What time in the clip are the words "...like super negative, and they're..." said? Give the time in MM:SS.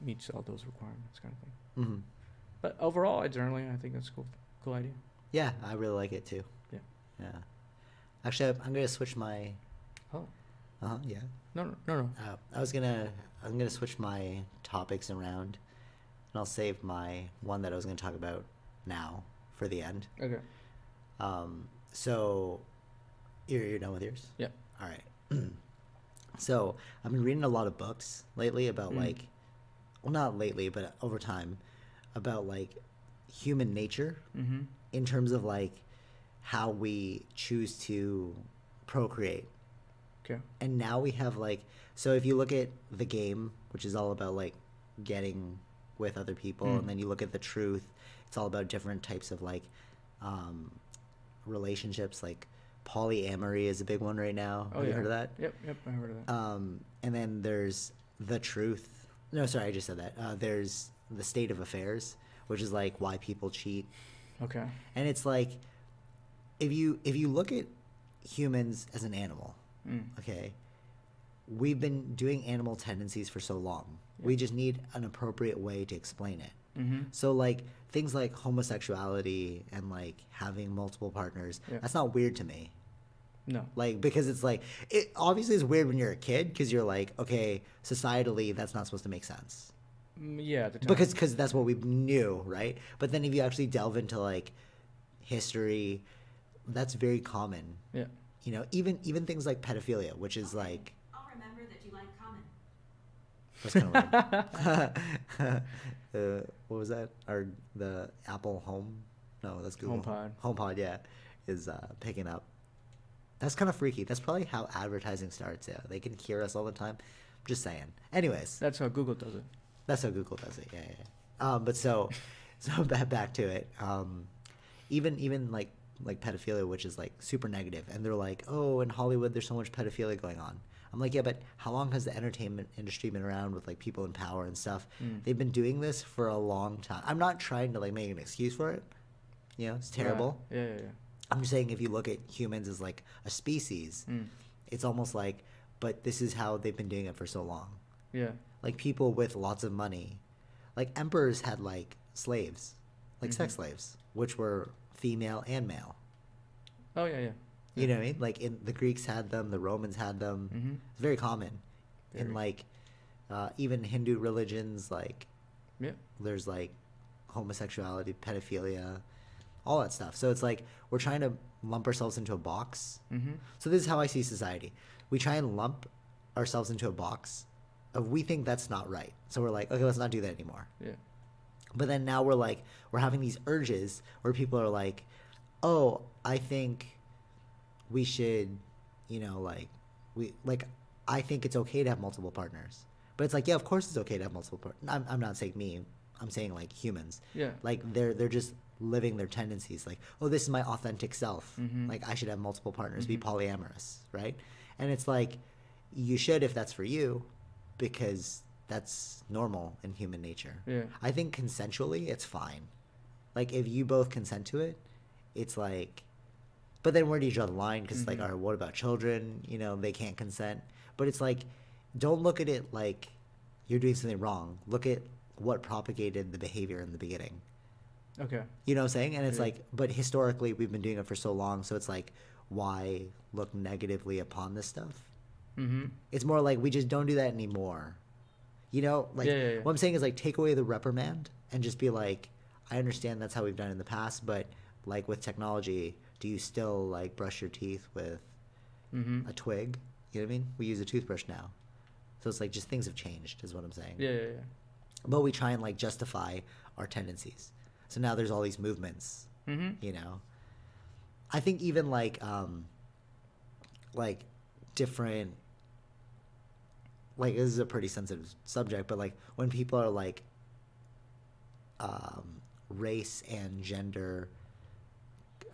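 02:06.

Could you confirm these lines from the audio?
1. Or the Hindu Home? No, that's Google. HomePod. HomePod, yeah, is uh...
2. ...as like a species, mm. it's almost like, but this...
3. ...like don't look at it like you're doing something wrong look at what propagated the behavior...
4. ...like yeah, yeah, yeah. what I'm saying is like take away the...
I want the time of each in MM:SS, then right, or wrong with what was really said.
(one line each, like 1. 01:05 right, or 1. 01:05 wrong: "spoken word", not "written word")
1. 01:47 wrong: "Apple", not "Hindu"
2. 02:22 right
3. 03:41 right
4. 03:59 right.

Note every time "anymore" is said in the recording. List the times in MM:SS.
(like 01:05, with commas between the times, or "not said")
03:00, 03:57.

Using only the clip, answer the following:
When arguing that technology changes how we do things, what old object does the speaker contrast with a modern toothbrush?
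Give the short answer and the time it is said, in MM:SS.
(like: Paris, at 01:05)
A twig, at 04:09.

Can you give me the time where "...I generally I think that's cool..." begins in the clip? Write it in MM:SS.
00:03.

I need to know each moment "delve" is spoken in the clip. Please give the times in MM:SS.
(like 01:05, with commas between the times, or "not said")
01:33.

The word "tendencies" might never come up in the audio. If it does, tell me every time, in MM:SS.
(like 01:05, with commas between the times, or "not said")
01:12, 03:19, 04:16.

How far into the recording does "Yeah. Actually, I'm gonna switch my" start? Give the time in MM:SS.
00:07.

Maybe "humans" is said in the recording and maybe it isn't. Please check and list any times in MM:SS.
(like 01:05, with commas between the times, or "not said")
00:33, 01:08, 02:22, 03:16, 03:29.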